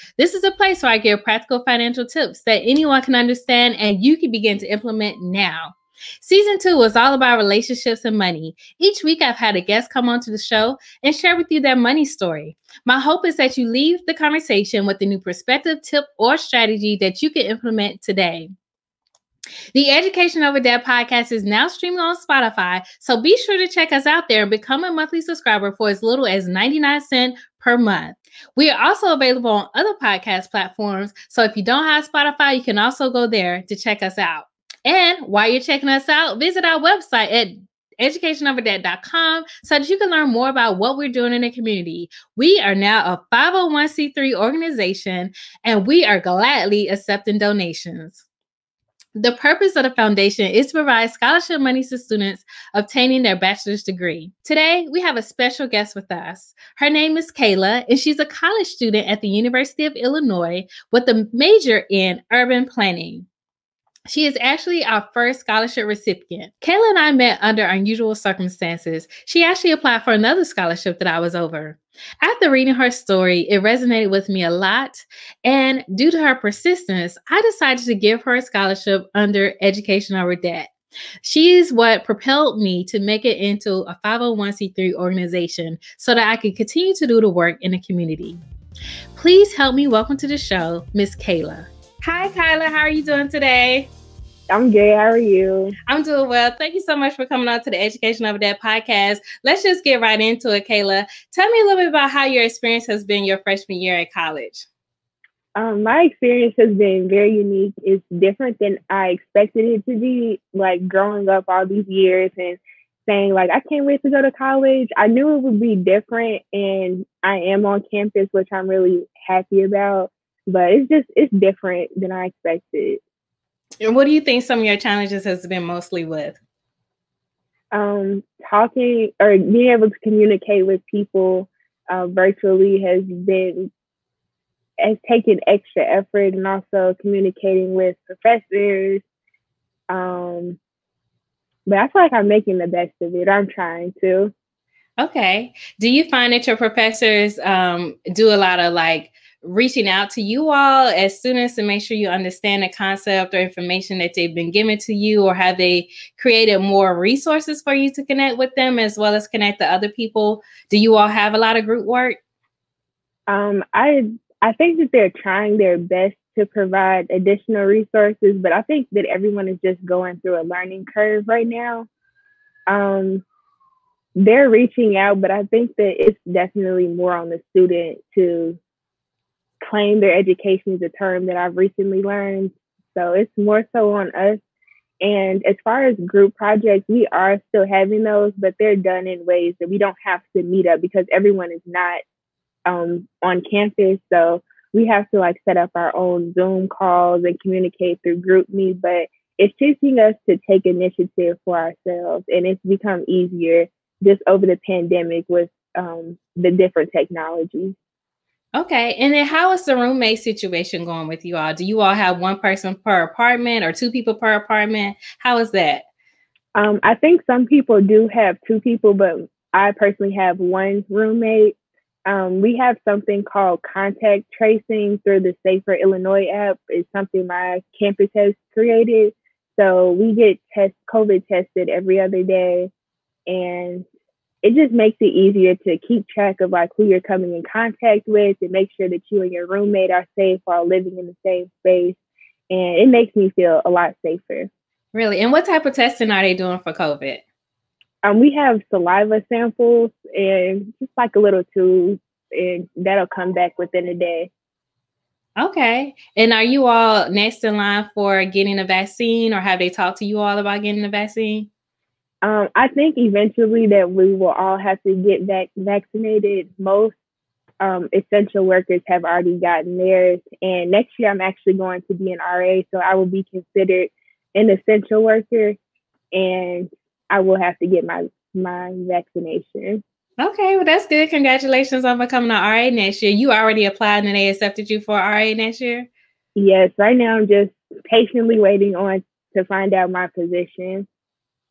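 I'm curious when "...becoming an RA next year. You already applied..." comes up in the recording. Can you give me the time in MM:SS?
04:41.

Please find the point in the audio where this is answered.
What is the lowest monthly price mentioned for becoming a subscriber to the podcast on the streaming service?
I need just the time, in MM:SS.
00:26.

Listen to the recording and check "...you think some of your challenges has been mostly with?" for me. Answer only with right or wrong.
right.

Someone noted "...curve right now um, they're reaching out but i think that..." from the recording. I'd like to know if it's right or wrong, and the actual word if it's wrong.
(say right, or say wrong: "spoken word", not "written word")
right.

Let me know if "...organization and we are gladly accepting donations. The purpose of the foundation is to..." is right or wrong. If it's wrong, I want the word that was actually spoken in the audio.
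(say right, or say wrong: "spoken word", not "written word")
right.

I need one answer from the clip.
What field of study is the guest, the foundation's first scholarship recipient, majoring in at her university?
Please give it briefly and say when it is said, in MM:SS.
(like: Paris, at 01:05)
Urban planning, at 01:02.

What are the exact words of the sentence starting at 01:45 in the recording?
Um, my experience has been very unique.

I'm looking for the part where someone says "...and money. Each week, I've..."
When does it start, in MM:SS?
00:08.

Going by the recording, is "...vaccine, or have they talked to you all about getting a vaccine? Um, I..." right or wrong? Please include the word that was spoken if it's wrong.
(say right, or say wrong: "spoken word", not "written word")
right.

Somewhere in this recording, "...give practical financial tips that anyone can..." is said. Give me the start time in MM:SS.
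00:00.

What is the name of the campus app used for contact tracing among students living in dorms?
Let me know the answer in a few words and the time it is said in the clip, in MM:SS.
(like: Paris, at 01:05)
Safer Illinois, at 03:45.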